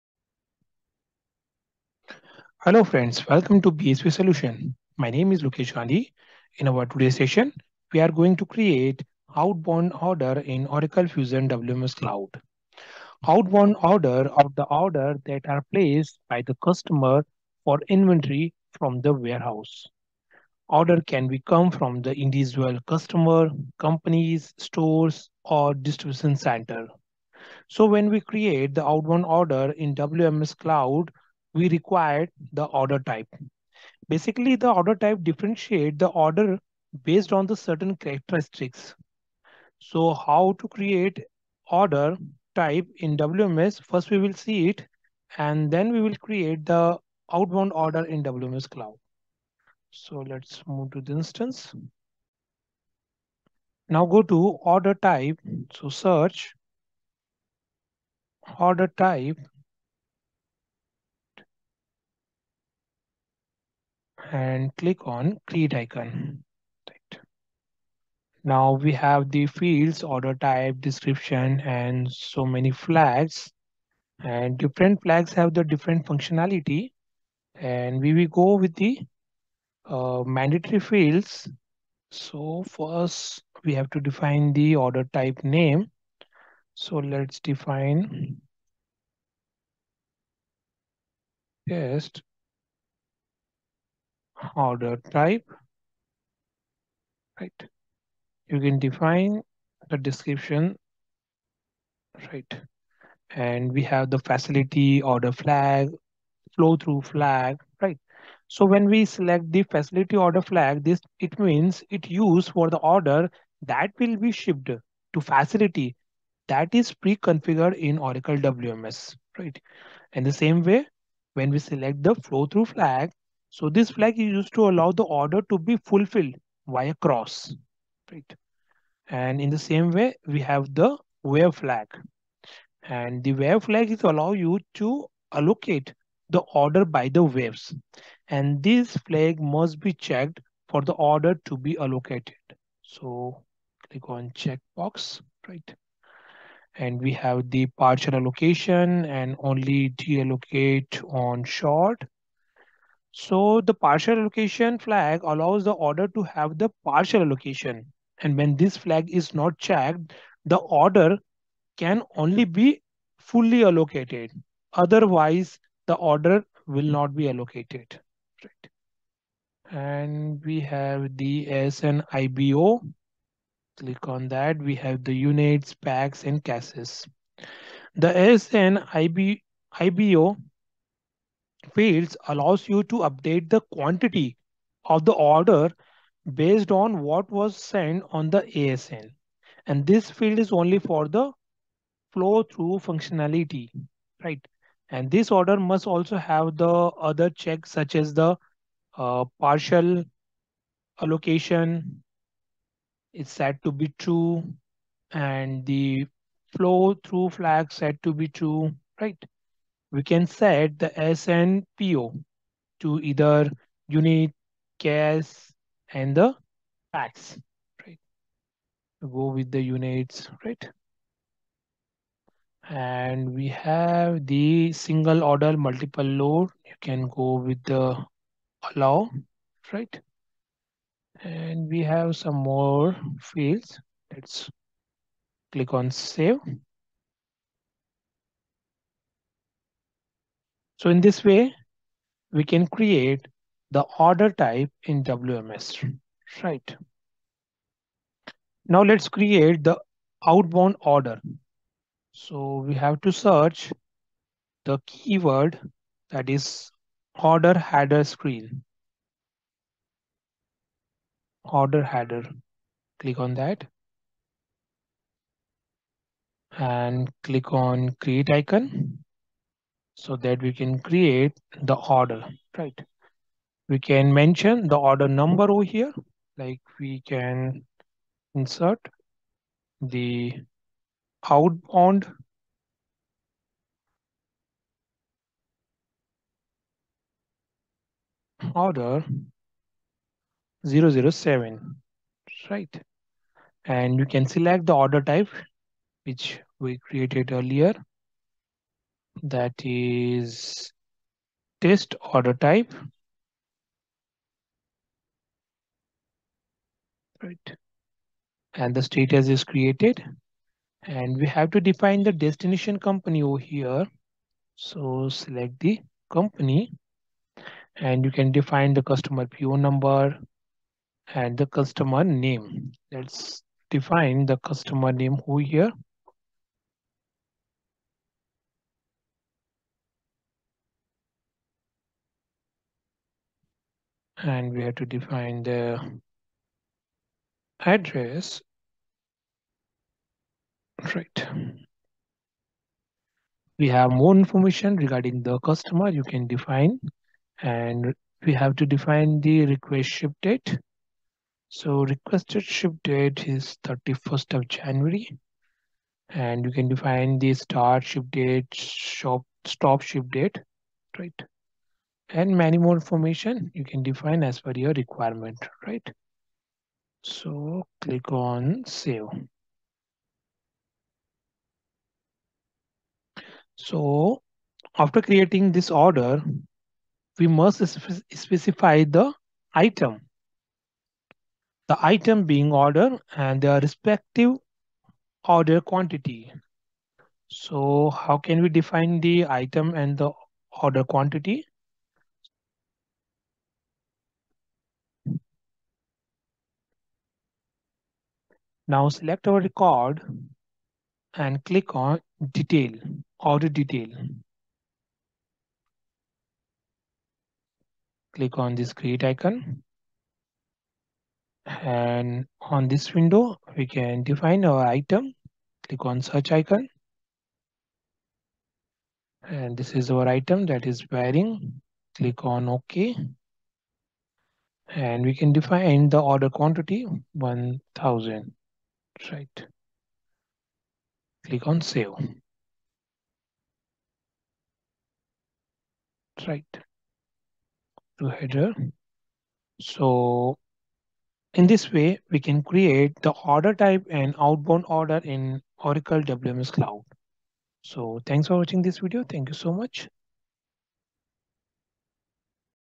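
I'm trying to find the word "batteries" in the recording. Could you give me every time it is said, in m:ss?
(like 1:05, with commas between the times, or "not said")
not said.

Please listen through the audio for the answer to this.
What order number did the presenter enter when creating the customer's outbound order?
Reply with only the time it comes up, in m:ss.
4:50.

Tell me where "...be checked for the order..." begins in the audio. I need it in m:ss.
2:19.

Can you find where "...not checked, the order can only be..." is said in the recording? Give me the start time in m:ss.
2:39.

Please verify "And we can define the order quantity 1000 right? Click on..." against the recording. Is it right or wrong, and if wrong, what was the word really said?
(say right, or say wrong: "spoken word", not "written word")
right.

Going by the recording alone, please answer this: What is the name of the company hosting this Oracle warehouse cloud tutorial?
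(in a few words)
BISP Solution.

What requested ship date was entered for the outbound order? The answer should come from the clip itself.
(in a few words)
31 January.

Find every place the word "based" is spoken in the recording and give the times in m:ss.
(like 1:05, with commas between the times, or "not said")
0:37, 3:06.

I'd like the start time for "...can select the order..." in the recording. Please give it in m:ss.
4:54.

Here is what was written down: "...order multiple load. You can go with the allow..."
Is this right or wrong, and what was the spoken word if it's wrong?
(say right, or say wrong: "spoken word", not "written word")
right.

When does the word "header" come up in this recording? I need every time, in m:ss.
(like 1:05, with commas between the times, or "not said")
4:17, 4:21, 7:18.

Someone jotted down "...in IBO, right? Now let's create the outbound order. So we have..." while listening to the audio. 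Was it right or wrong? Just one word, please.
wrong.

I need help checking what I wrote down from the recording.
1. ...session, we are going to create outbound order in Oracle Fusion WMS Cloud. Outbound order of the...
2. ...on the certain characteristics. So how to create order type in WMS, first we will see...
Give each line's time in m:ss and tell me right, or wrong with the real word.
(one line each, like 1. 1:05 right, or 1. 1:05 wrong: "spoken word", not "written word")
1. 0:07 right
2. 0:37 right.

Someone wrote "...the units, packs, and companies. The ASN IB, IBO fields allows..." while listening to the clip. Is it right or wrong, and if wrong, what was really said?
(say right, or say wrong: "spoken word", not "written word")
wrong: "cases", not "companies".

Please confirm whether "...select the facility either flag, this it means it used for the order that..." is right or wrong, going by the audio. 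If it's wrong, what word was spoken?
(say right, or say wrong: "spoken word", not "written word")
wrong: "order", not "either".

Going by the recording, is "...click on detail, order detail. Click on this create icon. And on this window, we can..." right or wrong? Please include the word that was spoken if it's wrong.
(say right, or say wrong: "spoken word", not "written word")
right.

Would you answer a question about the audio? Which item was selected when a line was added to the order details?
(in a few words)
wearing.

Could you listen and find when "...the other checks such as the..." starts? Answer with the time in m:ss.
3:16.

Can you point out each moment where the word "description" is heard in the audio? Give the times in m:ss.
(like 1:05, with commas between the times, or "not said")
1:10, 1:39.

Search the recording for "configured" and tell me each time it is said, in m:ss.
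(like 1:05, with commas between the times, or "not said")
1:56.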